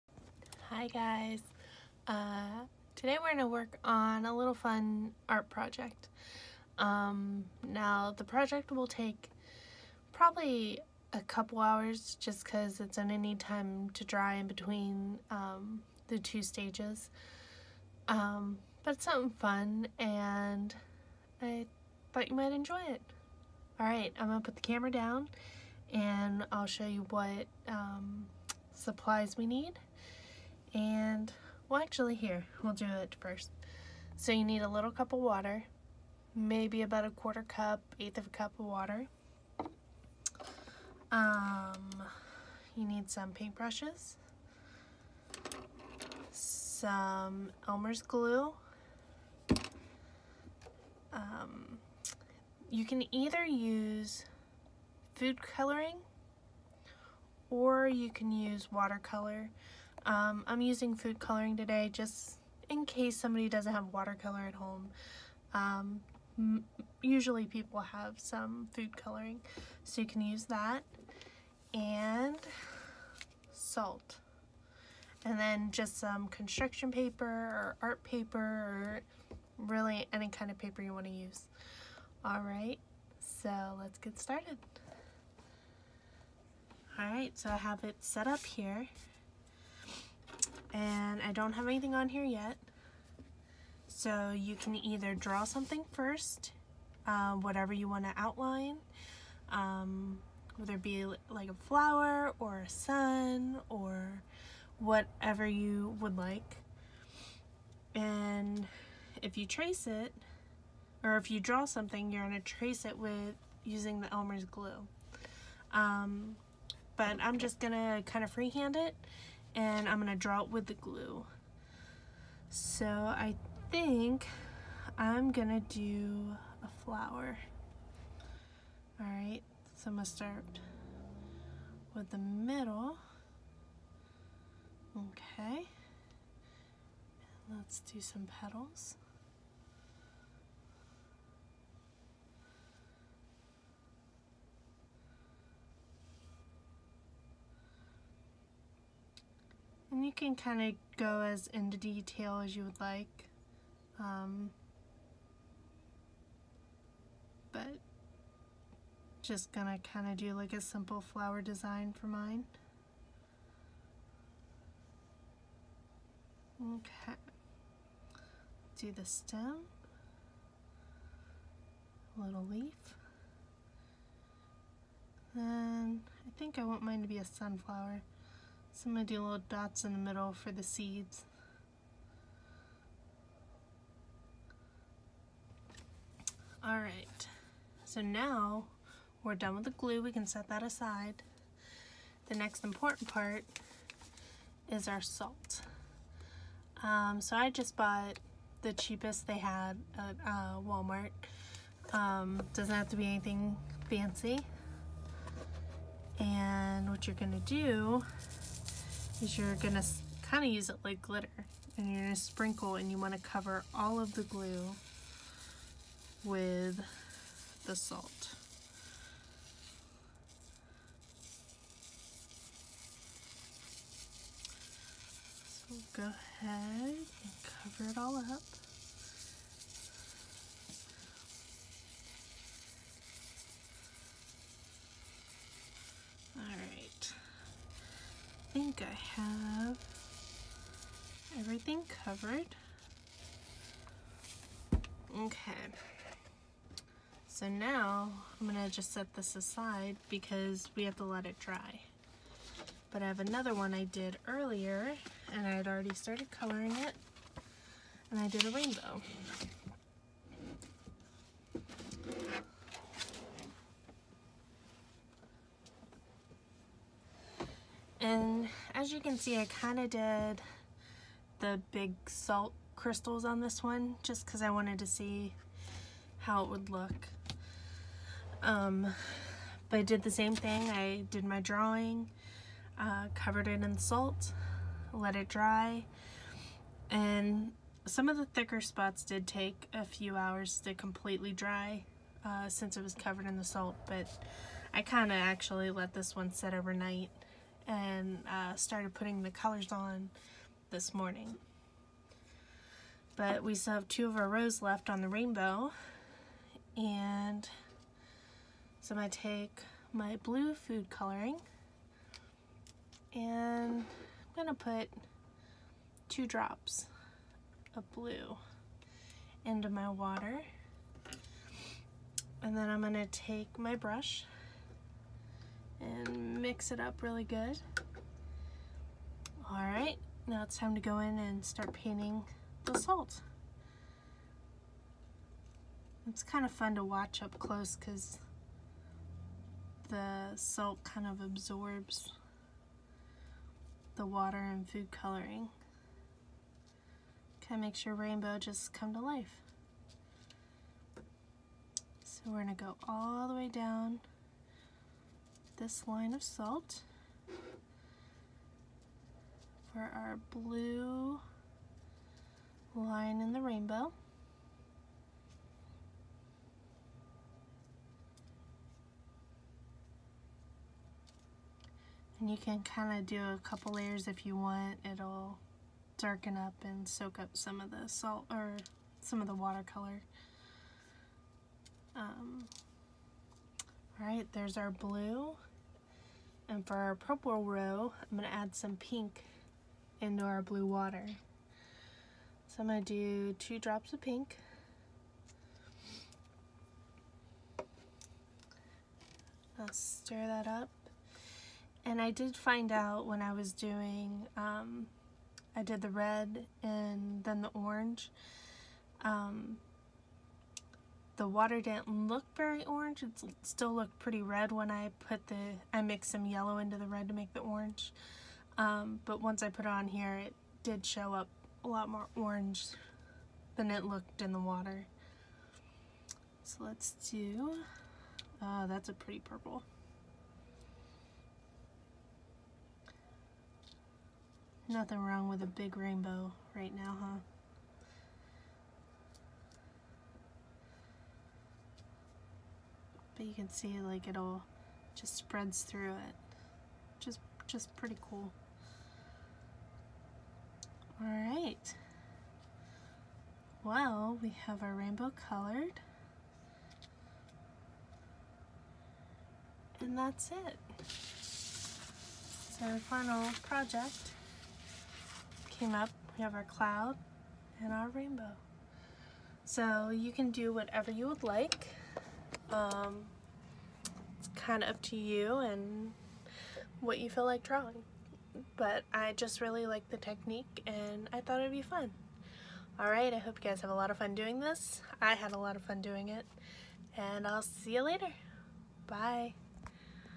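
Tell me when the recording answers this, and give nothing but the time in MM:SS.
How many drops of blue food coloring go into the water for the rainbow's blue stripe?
05:16.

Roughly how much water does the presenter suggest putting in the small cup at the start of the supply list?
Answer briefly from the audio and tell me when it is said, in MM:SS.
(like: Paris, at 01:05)
a quarter cup, at 00:36.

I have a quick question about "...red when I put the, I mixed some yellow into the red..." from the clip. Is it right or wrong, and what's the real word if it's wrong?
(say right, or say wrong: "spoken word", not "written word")
right.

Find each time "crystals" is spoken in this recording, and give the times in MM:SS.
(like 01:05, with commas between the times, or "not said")
04:32.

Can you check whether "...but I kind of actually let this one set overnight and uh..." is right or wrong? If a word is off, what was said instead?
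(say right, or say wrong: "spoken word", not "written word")
right.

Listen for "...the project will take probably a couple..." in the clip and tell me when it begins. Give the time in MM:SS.
00:08.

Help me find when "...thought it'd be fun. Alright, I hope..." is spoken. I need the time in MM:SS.
08:01.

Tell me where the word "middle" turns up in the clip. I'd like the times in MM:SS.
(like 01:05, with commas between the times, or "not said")
02:12, 02:59.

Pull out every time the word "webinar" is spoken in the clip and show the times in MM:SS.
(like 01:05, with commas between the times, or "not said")
not said.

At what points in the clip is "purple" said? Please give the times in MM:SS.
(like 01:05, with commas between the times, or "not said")
06:26, 07:09.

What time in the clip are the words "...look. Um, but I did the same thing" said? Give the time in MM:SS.
04:36.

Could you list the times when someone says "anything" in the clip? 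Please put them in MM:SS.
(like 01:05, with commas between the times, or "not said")
01:31, 03:23.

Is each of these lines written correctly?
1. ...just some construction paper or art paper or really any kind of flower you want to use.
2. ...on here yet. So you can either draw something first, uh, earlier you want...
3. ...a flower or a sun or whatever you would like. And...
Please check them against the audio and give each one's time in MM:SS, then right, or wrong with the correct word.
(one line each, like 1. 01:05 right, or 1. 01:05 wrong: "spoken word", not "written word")
1. 01:15 wrong: "paper", not "flower"
2. 01:31 wrong: "whatever", not "earlier"
3. 01:41 right.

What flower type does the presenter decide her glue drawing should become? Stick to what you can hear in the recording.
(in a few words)
a sunflower.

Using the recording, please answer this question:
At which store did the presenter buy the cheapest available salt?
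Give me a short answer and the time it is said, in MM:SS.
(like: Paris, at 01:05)
Walmart, at 03:20.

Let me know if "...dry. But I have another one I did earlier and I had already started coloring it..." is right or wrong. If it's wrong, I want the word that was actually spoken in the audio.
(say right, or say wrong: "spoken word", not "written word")
right.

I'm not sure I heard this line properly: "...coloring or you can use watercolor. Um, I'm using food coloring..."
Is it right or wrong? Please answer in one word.
right.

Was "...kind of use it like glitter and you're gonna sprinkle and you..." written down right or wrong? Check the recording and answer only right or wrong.
right.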